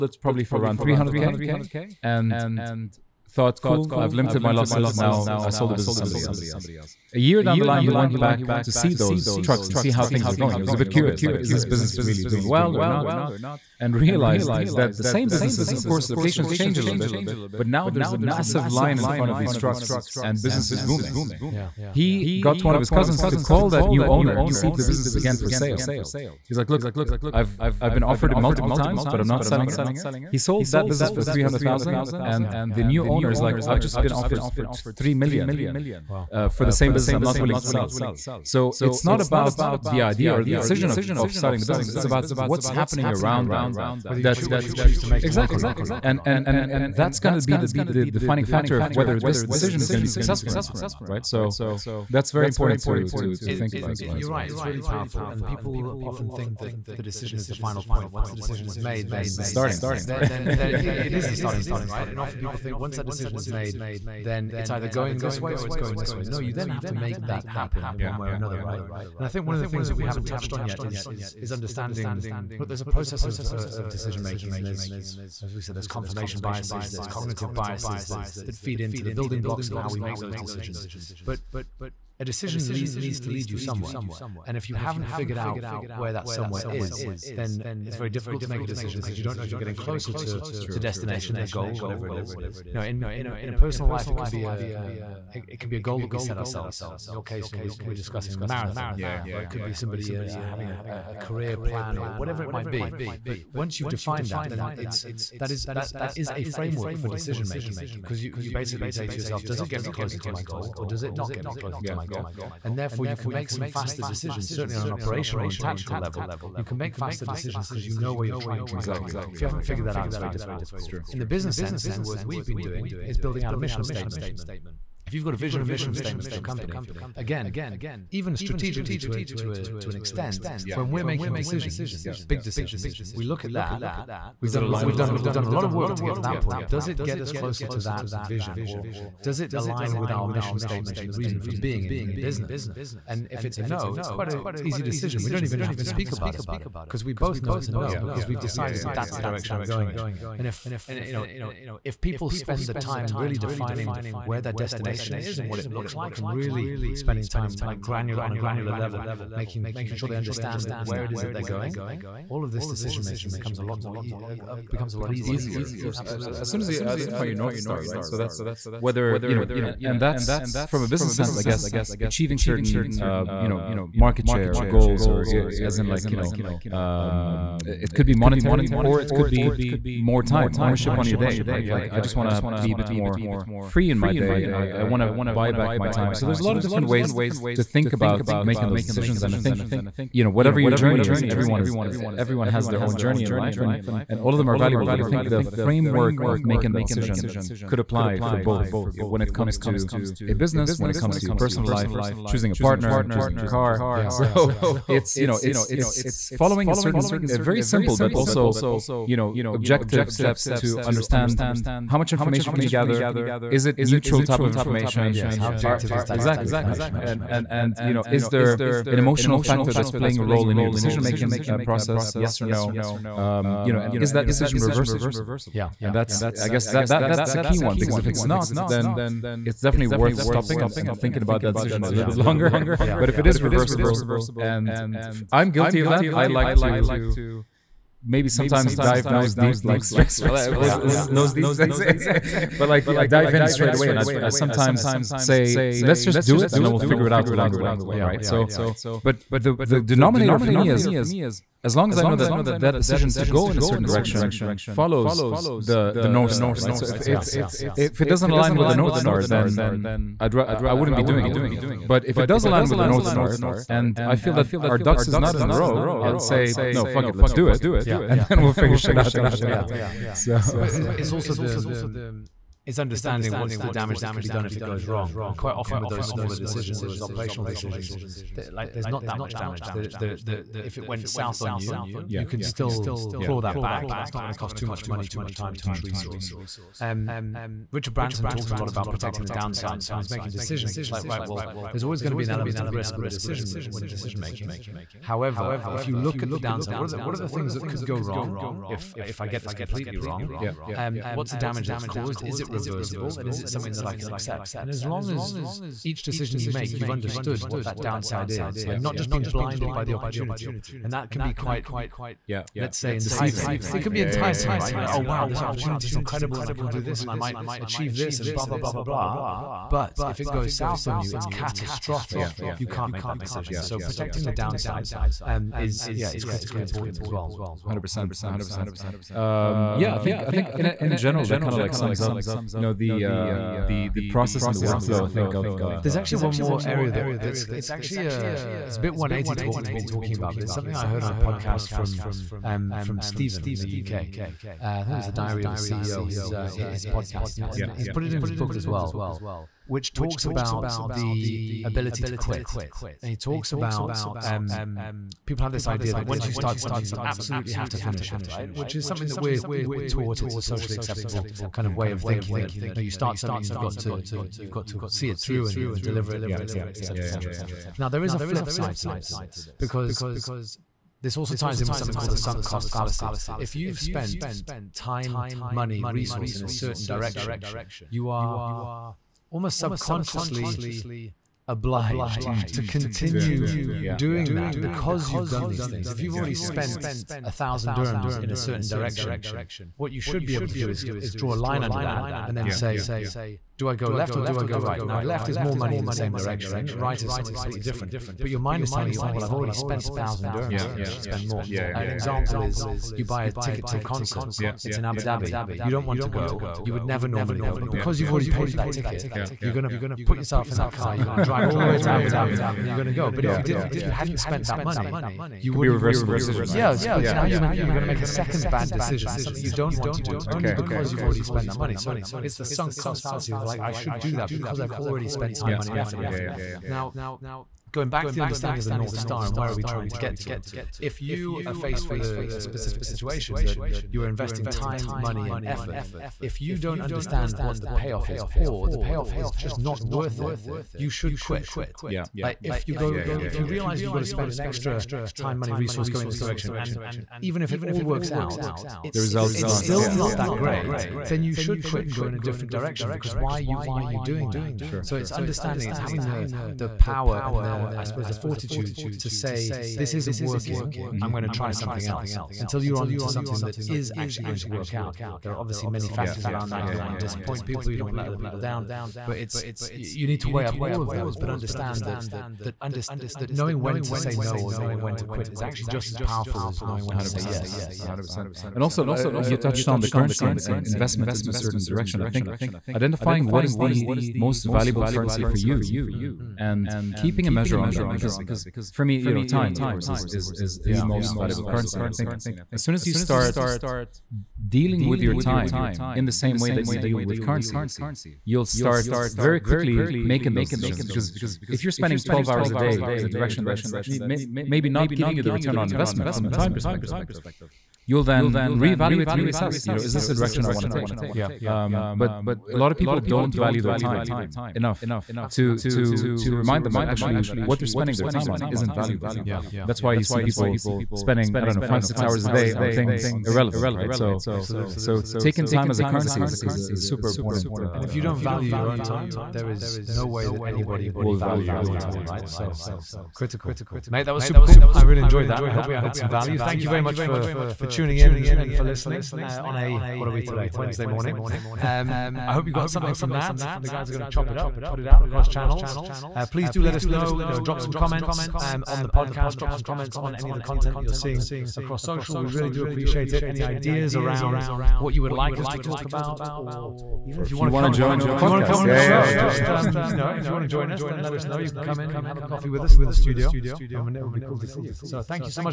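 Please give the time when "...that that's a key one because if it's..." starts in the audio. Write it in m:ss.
3:46.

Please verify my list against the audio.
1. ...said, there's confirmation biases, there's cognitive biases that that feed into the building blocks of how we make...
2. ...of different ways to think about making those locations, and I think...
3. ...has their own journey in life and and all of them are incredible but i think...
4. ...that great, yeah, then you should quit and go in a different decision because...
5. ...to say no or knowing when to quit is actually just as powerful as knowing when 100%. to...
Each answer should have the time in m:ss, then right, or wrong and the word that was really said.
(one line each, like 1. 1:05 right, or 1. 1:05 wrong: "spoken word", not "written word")
1. 1:15 right
2. 3:06 wrong: "decisions", not "locations"
3. 3:12 wrong: "valuable", not "incredible"
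4. 7:30 wrong: "direction", not "decision"
5. 7:53 right.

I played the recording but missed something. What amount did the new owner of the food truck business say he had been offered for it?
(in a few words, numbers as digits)
3 million.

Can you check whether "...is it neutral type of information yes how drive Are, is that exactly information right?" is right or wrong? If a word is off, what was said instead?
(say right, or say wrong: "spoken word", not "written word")
wrong: "objective", not "drive".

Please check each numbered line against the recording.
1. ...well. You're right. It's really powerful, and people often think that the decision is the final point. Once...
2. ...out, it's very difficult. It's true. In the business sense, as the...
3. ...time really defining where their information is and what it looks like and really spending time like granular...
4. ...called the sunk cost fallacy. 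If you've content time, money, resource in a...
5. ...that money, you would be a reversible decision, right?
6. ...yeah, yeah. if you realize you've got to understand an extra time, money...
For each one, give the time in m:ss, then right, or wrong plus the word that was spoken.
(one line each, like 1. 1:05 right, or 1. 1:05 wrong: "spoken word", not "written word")
1. 0:54 right
2. 1:59 right
3. 2:32 wrong: "destination", not "information"
4. 6:12 wrong: "spent", not "content"
5. 6:54 right
6. 7:22 wrong: "spend", not "understand".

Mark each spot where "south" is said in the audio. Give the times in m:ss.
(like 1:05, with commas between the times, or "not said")
4:41, 5:20.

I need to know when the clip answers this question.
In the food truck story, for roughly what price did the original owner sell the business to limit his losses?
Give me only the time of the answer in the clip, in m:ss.
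0:00.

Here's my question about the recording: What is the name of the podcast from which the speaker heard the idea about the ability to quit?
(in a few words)
The Diary of a CEO.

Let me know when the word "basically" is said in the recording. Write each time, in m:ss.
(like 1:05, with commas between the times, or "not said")
1:48.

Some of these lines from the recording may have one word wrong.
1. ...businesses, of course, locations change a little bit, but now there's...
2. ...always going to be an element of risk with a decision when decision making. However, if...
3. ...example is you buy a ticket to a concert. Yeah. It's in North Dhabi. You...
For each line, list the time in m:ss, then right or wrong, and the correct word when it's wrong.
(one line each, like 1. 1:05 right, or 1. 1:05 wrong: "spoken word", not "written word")
1. 0:15 right
2. 4:51 right
3. 6:41 wrong: "Abu", not "North".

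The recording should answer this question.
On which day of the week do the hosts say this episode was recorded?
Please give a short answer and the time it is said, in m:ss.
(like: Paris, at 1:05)
Wednesday, at 9:00.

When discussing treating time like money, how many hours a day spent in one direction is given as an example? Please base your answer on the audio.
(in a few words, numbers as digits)
12.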